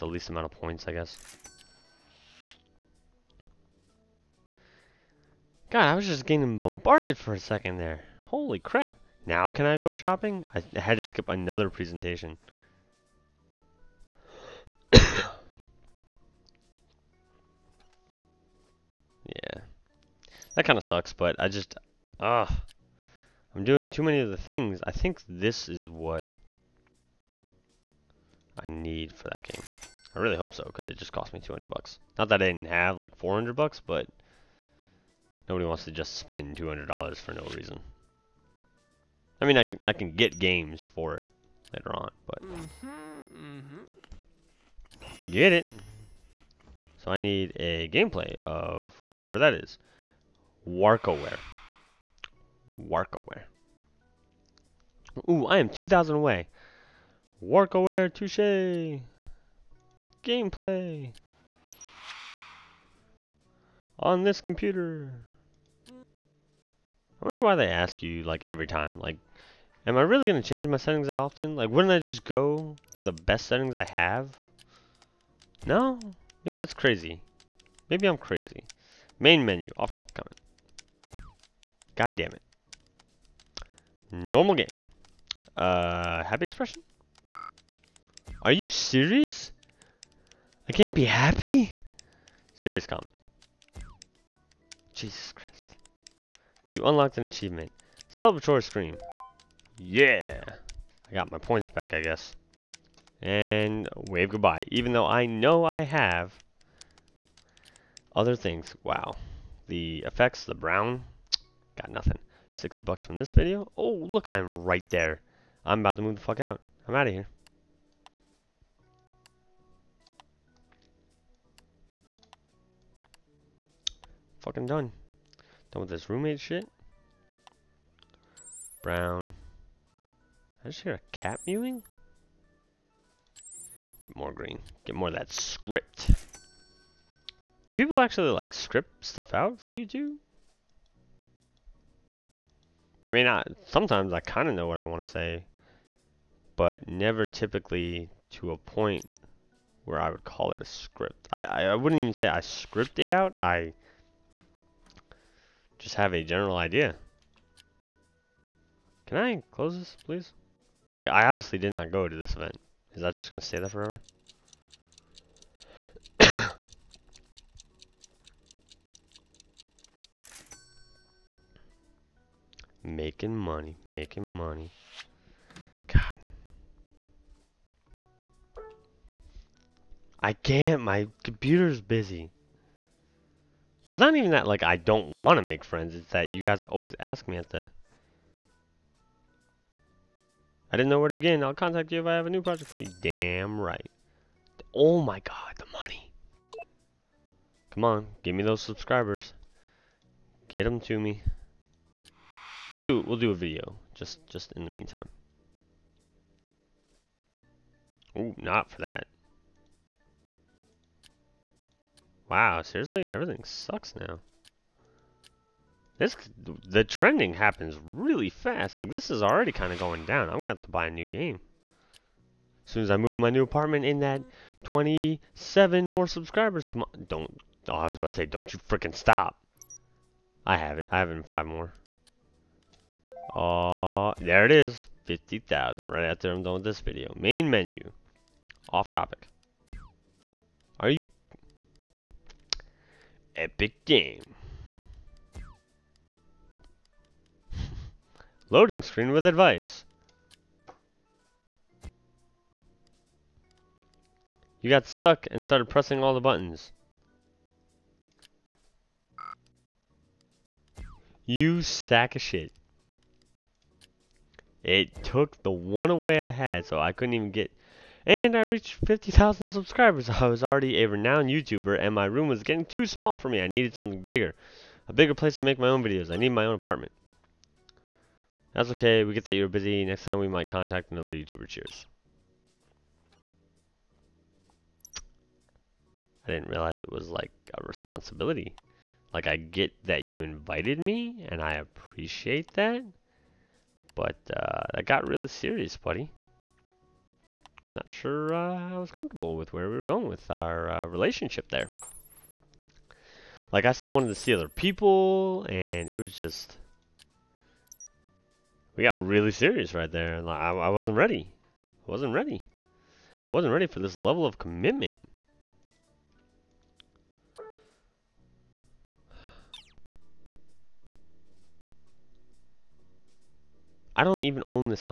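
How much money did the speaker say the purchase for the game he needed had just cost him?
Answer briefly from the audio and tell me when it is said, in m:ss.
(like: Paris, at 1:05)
$200, at 0:31.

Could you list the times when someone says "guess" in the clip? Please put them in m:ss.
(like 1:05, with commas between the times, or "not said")
0:00, 1:41.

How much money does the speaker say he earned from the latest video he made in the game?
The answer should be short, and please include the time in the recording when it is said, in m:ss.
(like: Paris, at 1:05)
$60, at 1:52.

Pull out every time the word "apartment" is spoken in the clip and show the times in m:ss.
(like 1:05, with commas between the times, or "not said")
3:43, 4:36.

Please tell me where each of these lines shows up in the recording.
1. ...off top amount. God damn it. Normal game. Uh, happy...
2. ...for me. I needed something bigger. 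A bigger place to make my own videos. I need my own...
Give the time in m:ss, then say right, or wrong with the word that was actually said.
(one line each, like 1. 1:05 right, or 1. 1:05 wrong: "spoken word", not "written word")
1. 1:19 wrong: "comment", not "amount"
2. 4:33 right.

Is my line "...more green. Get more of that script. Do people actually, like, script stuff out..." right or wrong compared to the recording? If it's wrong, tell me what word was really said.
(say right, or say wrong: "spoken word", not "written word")
right.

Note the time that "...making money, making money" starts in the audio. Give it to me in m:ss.
2:52.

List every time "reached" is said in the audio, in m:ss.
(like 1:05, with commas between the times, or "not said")
4:28.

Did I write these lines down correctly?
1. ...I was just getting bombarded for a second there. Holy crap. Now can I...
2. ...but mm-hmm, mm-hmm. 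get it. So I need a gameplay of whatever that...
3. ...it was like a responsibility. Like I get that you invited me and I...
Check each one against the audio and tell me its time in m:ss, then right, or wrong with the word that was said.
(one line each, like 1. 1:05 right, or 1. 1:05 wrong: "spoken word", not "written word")
1. 0:05 right
2. 0:42 right
3. 4:46 right.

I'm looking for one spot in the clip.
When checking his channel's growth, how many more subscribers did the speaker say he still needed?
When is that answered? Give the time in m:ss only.
3:44.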